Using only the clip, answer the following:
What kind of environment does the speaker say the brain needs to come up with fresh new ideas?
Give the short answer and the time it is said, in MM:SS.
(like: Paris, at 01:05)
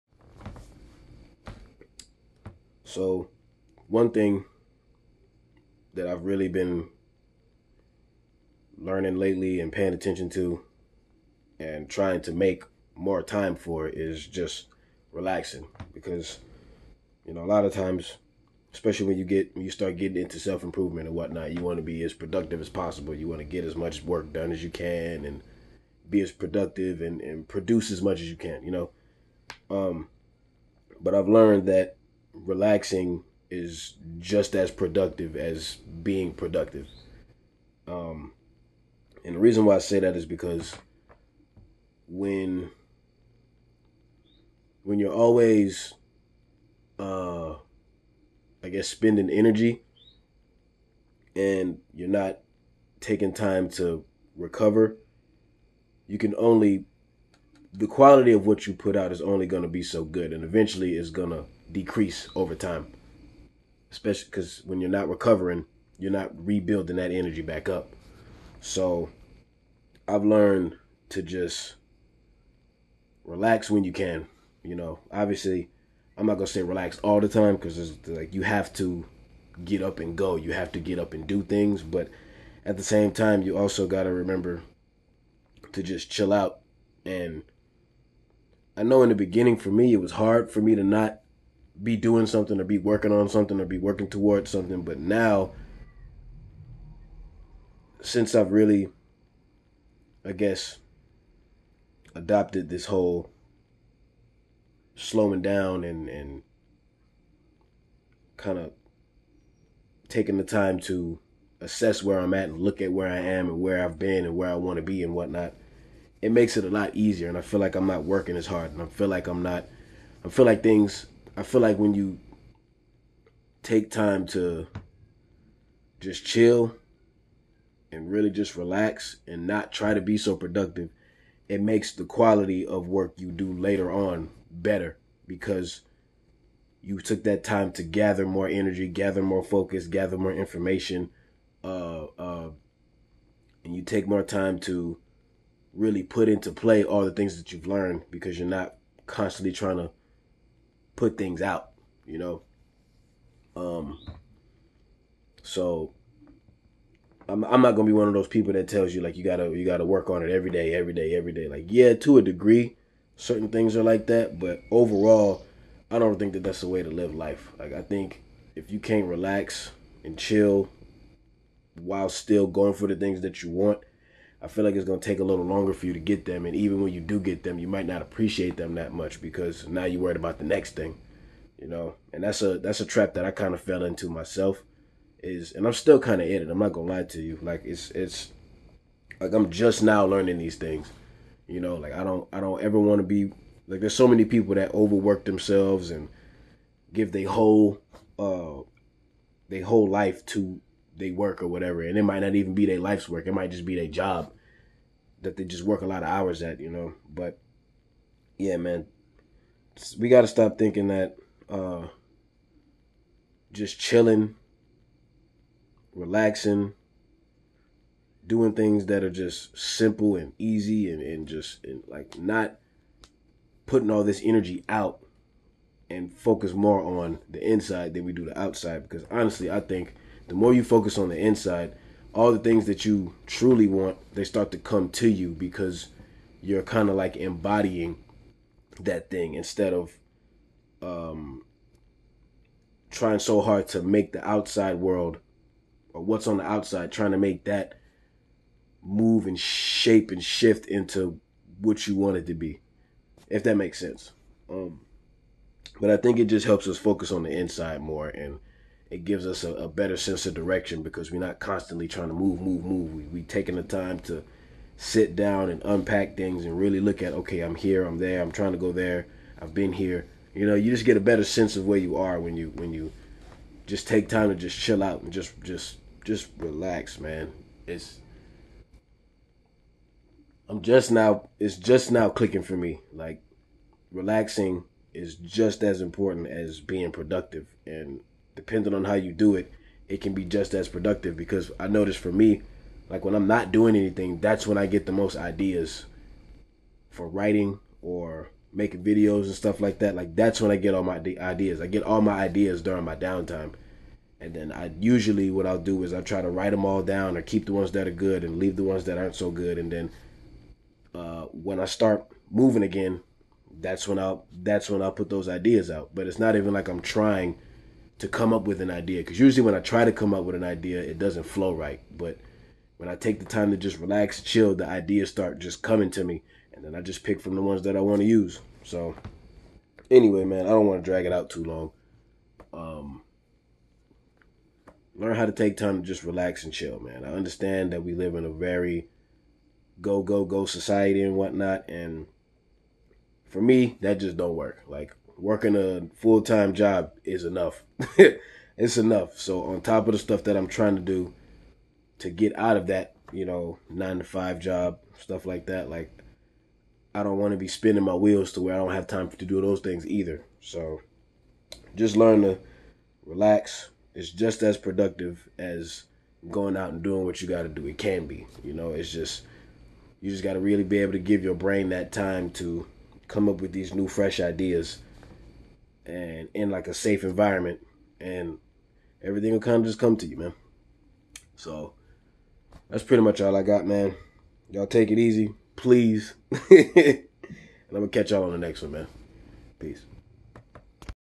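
Safe environment, at 06:16.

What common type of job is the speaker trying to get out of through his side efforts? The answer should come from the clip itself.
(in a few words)
Nine to five.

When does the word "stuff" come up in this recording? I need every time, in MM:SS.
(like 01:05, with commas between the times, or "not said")
04:59, 05:49, 05:54.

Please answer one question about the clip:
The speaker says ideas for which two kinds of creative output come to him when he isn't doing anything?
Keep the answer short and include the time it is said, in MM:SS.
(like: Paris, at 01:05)
Writing or making videos, at 04:57.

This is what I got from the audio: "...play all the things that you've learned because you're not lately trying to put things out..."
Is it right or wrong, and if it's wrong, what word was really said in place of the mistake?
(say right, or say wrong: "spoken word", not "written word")
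wrong: "constantly", not "lately".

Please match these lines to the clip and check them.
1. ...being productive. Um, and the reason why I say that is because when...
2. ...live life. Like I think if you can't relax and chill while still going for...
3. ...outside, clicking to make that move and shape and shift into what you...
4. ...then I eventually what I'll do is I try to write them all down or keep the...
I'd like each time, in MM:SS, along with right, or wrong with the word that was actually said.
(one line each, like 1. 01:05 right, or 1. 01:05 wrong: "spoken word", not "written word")
1. 00:35 right
2. 02:46 right
3. 04:06 wrong: "trying", not "clicking"
4. 05:04 wrong: "usually", not "eventually".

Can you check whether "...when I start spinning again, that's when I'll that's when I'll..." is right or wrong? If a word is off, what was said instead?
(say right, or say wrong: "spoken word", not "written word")
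wrong: "moving", not "spinning".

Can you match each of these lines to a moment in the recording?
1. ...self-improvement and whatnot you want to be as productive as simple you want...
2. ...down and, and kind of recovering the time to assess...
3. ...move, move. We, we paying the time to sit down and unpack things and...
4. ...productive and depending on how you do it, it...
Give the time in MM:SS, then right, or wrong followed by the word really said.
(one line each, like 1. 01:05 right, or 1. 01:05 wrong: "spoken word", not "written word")
1. 00:20 wrong: "possible", not "simple"
2. 01:45 wrong: "taking", not "recovering"
3. 04:22 wrong: "taking", not "paying"
4. 04:46 right.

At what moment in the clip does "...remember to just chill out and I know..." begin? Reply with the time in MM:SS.
01:24.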